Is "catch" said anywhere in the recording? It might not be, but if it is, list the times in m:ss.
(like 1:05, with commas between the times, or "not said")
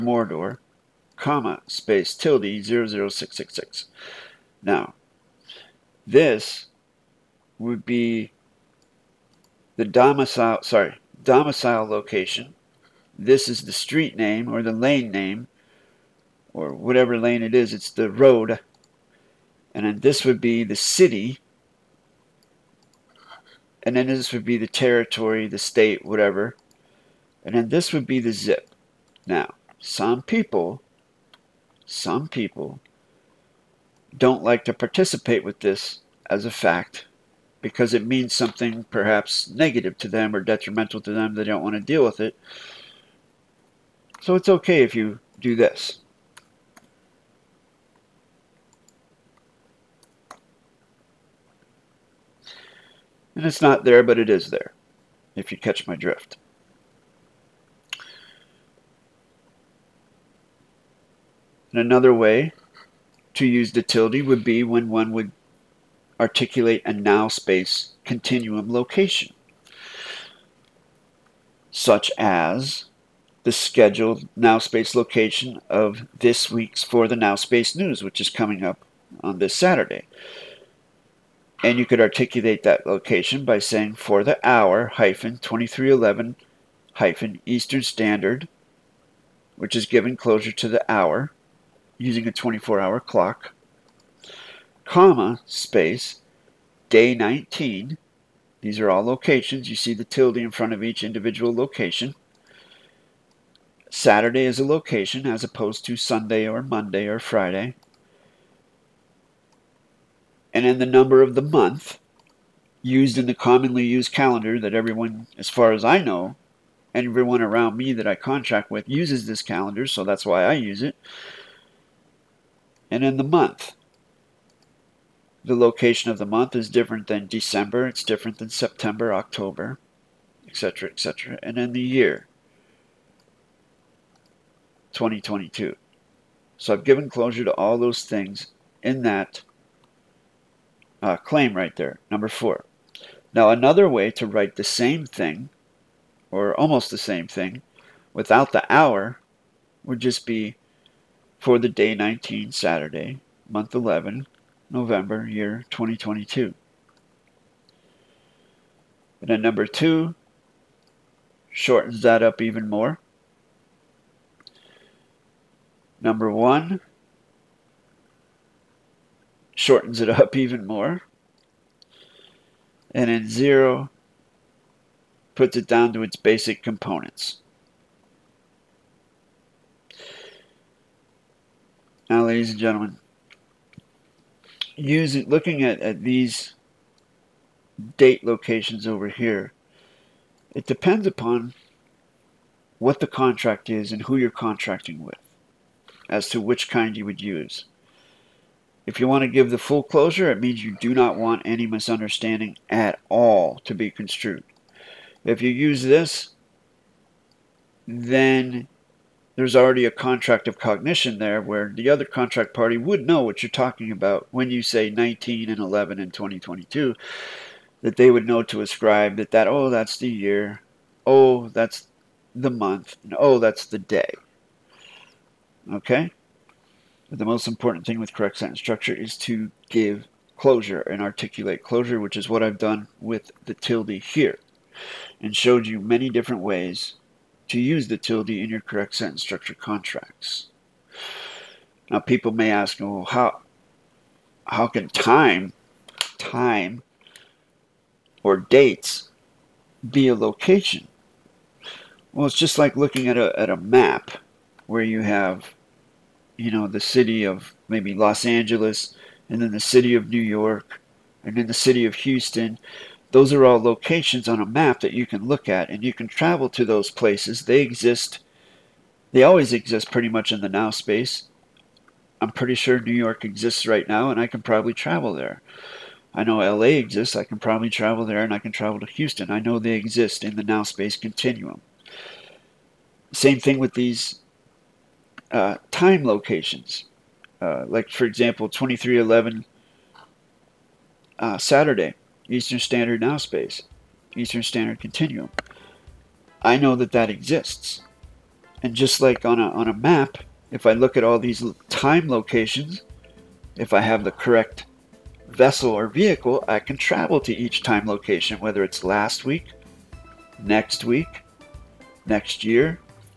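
0:55.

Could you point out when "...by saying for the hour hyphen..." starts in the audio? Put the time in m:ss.
1:23.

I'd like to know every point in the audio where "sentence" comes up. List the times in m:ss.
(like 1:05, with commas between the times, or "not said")
3:48, 3:58.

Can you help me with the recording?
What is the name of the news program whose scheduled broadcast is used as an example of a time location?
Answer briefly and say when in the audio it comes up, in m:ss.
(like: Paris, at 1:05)
For the Now Space News, at 1:16.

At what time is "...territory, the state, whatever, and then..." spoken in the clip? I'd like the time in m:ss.
0:24.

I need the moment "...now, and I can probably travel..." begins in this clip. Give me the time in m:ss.
4:33.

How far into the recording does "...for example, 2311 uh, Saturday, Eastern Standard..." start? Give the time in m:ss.
4:47.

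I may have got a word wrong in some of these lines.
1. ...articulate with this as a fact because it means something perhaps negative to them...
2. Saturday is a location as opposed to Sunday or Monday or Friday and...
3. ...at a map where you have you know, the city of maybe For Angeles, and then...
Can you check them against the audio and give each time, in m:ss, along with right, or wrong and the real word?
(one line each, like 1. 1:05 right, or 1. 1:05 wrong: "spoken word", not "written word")
1. 0:34 wrong: "participate", not "articulate"
2. 1:43 right
3. 4:13 wrong: "Los", not "For".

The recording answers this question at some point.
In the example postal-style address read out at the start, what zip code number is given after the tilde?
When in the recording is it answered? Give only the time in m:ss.
0:02.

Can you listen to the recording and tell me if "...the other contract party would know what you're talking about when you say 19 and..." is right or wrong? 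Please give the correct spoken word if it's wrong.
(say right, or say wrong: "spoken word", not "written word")
right.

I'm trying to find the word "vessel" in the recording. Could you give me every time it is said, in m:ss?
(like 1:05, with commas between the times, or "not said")
5:05.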